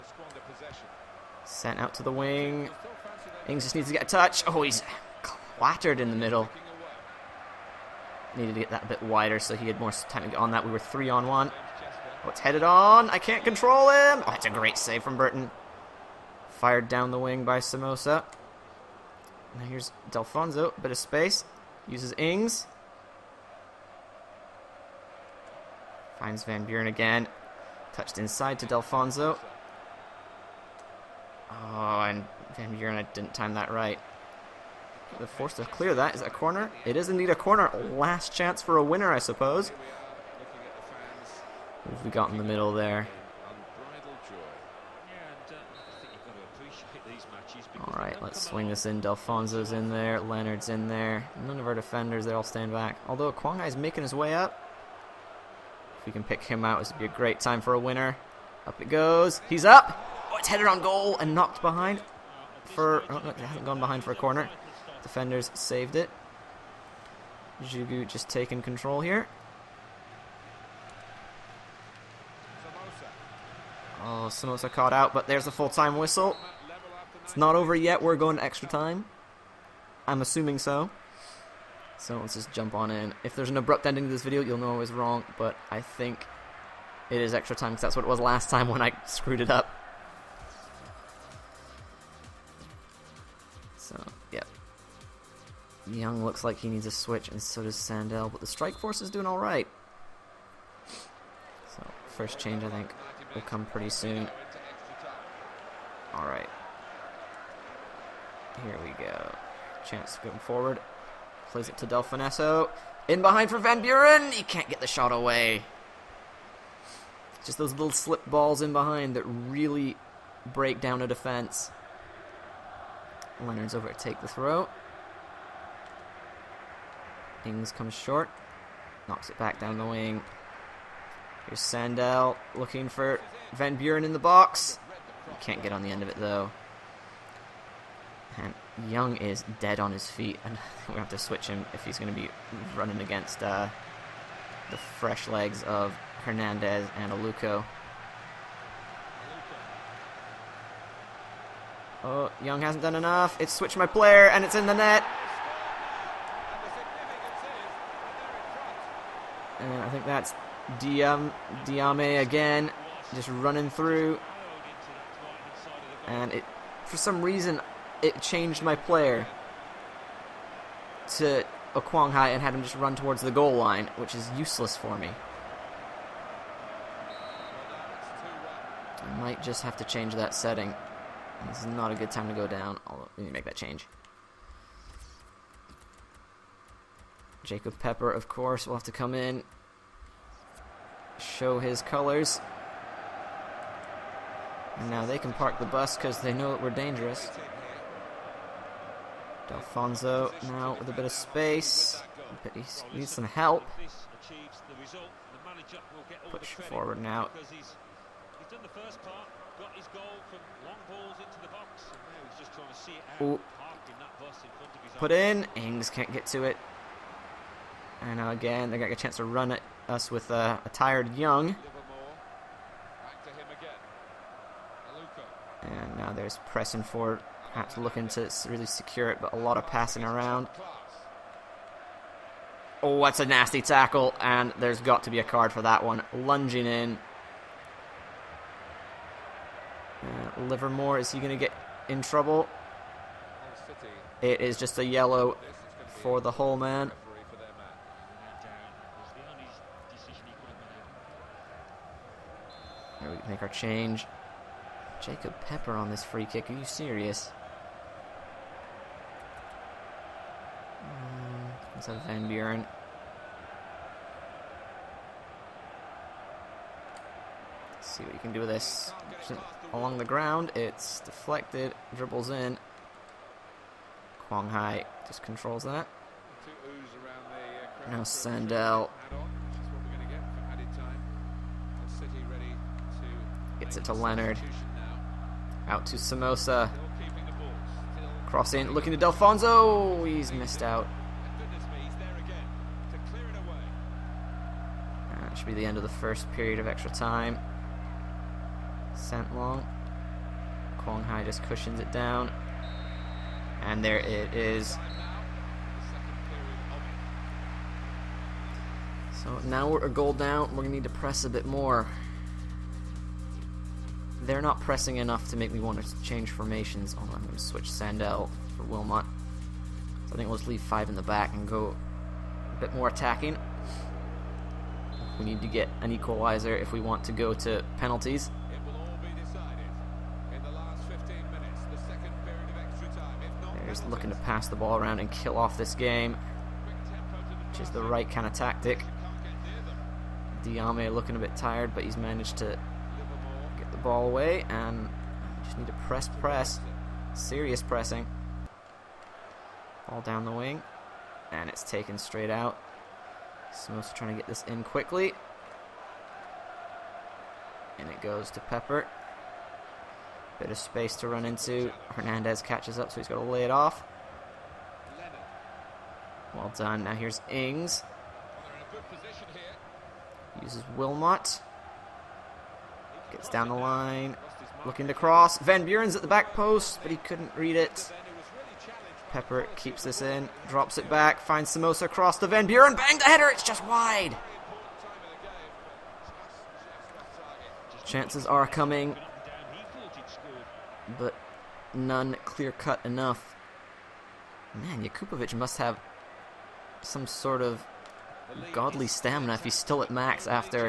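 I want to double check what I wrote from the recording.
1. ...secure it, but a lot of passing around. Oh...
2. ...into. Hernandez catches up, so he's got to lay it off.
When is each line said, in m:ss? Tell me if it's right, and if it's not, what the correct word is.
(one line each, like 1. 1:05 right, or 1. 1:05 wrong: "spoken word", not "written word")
1. 3:48 right
2. 6:01 right.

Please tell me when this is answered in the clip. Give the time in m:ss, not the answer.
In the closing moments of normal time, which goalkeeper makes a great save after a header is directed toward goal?
0:15.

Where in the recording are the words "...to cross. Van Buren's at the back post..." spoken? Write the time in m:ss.
6:14.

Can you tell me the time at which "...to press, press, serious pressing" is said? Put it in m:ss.
5:45.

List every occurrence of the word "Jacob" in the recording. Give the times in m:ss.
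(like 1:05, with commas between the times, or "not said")
3:07, 4:15.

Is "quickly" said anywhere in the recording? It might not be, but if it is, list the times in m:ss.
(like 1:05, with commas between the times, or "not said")
5:54.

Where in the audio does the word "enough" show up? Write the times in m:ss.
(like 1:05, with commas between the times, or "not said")
2:32, 5:14, 6:32.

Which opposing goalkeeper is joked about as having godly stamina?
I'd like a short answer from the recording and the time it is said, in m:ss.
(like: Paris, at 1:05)
Jakupovic, at 6:34.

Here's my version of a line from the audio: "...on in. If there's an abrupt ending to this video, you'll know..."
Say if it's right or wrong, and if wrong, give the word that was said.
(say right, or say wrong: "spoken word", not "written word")
right.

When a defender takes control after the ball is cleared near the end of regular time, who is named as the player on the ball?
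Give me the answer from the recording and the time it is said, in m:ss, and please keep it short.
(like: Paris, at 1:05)
Jugu, at 1:07.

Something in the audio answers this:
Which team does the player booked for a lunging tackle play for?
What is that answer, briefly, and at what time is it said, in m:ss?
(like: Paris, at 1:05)
Hull, at 4:06.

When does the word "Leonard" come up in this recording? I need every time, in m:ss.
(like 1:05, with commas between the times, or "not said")
0:50, 2:03, 4:43.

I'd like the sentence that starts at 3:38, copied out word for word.
And now again, they got a chance to run at us with a tired Young.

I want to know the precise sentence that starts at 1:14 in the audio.
Oh, Samosa caught out, but there's the full-time whistle.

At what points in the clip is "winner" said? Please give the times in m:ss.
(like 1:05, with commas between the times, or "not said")
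0:38, 0:57.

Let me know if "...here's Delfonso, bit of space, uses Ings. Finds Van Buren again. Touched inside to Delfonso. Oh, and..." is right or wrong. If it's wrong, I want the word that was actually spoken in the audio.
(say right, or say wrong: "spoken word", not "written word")
right.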